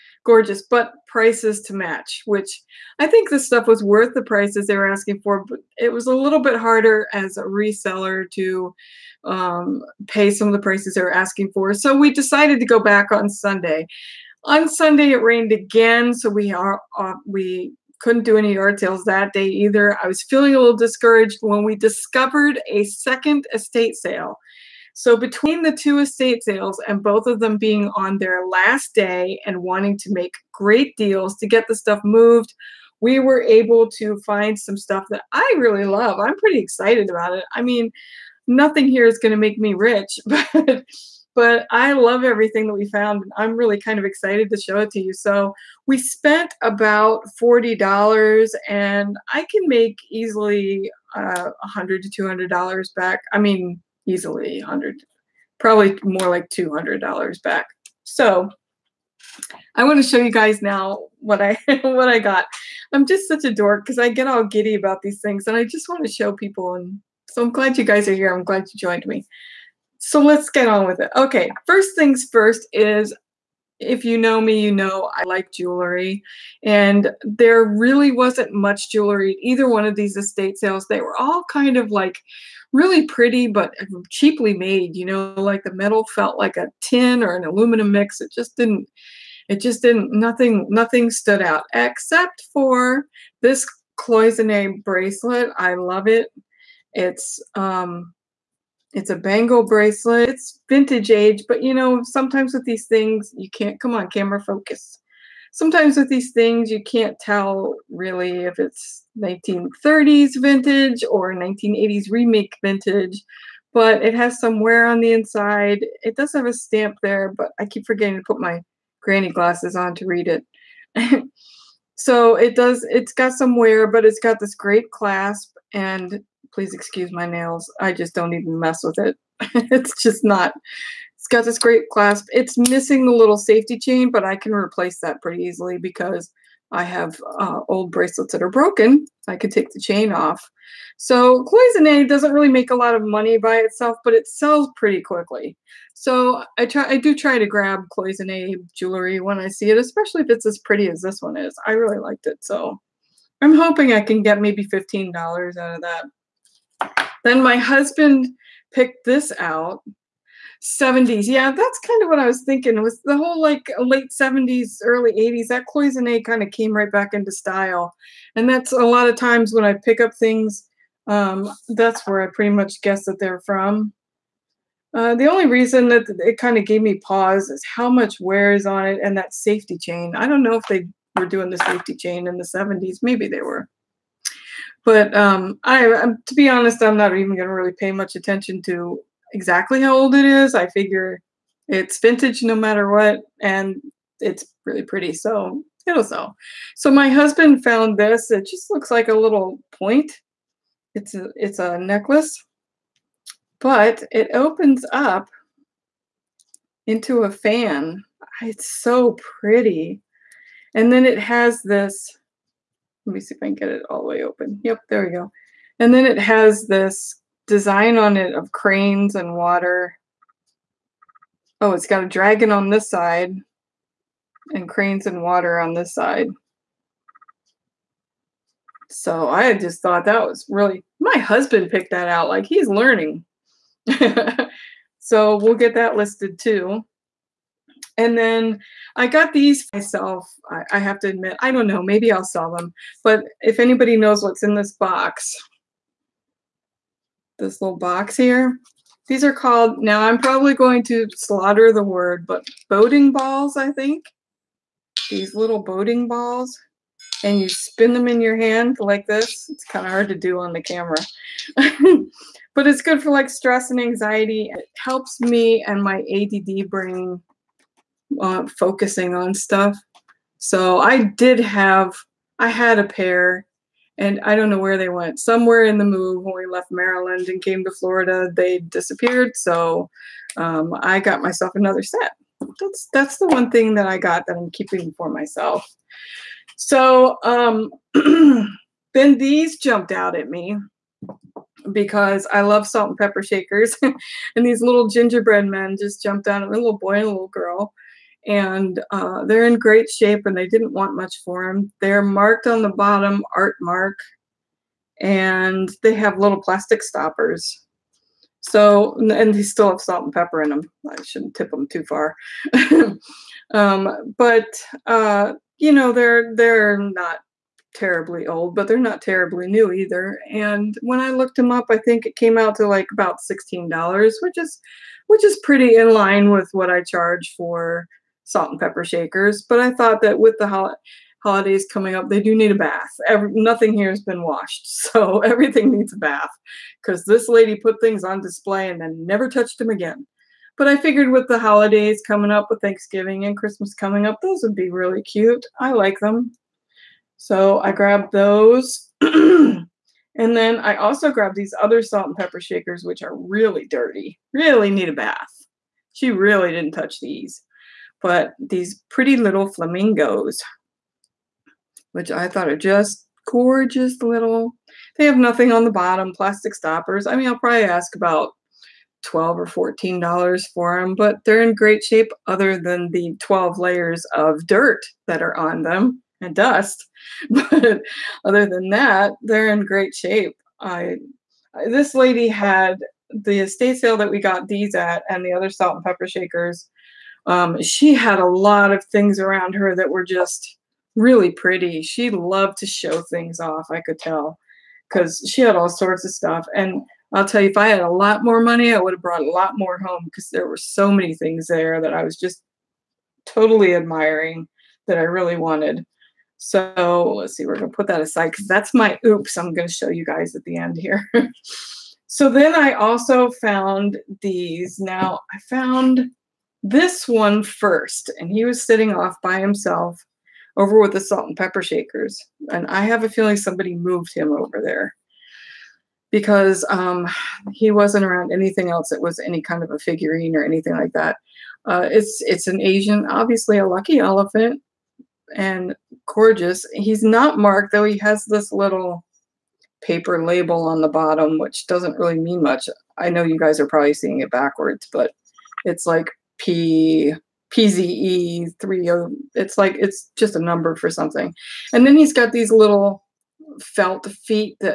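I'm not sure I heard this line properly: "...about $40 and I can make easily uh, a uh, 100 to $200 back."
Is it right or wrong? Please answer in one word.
right.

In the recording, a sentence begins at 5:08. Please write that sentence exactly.
So, and they still have salt and pepper in them.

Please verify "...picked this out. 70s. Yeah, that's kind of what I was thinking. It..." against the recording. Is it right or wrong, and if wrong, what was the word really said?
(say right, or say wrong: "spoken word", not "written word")
right.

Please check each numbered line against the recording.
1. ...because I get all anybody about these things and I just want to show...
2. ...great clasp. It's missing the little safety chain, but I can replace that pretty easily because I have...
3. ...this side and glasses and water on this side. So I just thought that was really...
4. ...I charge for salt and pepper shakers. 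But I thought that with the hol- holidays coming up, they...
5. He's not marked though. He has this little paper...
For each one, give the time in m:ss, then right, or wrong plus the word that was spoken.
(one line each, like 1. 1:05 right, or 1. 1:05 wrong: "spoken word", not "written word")
1. 1:03 wrong: "giddy", not "anybody"
2. 2:11 right
3. 3:42 wrong: "cranes", not "glasses"
4. 5:26 right
5. 7:16 right.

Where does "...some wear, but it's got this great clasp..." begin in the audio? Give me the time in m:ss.
2:03.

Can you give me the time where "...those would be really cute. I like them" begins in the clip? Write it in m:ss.
5:44.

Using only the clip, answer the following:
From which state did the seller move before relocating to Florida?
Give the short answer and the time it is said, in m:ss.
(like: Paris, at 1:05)
Maryland, at 4:36.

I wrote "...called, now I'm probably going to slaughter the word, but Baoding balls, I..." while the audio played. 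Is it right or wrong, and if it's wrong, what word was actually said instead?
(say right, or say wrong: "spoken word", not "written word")
right.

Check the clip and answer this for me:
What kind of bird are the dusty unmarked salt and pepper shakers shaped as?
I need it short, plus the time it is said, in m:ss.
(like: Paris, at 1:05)
flamingos, at 5:59.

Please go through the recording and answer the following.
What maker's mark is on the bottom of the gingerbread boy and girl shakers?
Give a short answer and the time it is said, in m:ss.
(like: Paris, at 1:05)
Artmark, at 5:03.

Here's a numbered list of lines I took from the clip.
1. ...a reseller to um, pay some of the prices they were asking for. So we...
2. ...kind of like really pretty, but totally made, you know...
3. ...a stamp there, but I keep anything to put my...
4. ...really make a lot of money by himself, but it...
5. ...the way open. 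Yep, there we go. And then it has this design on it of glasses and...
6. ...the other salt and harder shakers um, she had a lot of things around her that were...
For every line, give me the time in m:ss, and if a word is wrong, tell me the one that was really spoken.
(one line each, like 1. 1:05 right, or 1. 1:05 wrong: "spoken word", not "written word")
1. 0:07 right
2. 1:21 wrong: "cheaply", not "totally"
3. 1:56 wrong: "forgetting", not "anything"
4. 2:22 wrong: "itself", not "himself"
5. 3:34 wrong: "cranes", not "glasses"
6. 6:25 wrong: "pepper", not "harder".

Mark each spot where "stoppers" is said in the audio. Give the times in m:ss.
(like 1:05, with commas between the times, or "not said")
5:06, 6:06.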